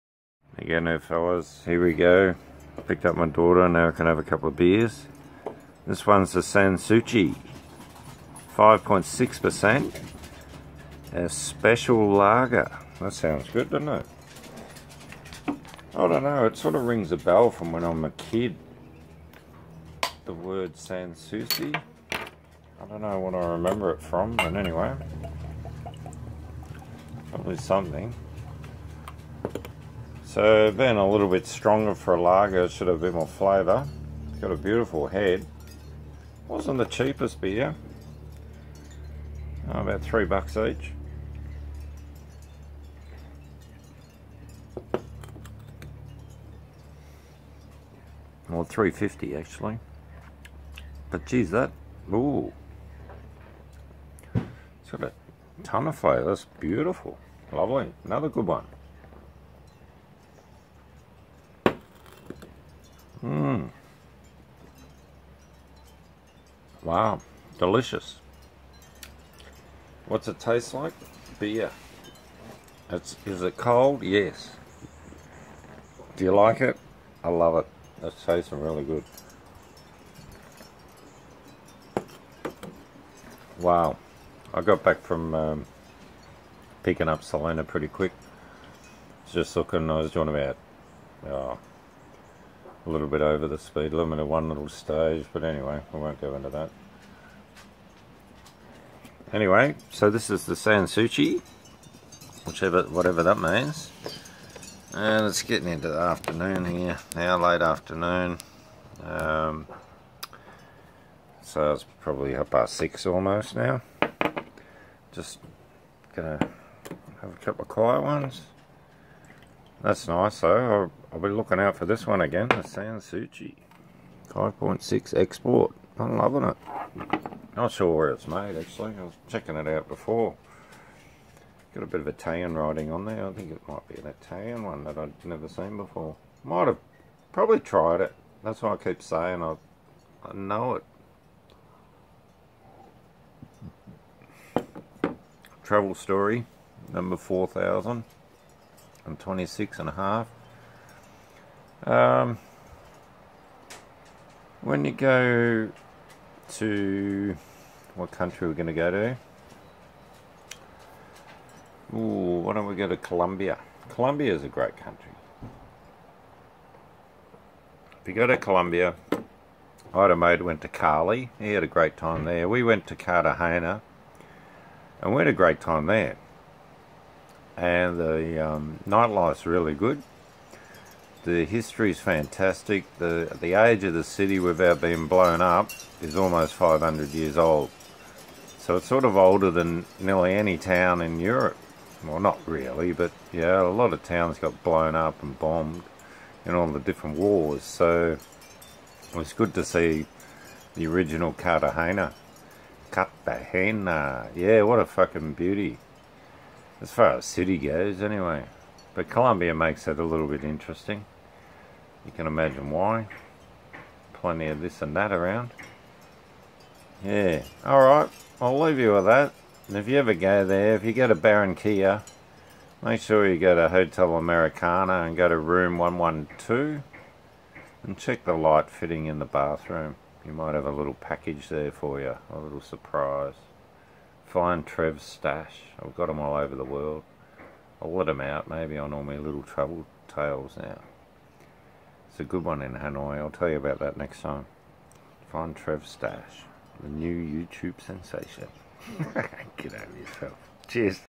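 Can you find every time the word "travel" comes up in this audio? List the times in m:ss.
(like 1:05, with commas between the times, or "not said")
2:25, 3:59.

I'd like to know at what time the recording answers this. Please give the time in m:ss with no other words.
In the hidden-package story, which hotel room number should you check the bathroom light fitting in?
3:45.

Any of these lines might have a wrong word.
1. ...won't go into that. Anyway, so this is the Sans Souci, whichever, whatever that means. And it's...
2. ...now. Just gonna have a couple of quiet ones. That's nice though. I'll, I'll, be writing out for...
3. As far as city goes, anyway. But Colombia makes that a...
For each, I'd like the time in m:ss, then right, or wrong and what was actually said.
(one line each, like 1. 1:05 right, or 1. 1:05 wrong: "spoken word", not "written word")
1. 1:35 right
2. 1:53 wrong: "looking", not "writing"
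3. 3:26 right.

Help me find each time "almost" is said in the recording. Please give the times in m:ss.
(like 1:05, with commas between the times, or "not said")
1:53, 3:06.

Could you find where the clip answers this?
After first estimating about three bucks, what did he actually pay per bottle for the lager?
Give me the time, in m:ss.
0:48.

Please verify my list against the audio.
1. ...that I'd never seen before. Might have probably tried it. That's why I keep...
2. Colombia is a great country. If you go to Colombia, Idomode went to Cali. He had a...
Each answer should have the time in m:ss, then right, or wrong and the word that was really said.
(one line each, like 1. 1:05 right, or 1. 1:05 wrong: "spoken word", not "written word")
1. 2:14 right
2. 2:43 right.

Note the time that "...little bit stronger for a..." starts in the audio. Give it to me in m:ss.
0:31.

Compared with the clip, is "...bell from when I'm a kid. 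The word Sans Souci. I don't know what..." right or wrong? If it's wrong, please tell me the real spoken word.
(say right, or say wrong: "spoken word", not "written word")
right.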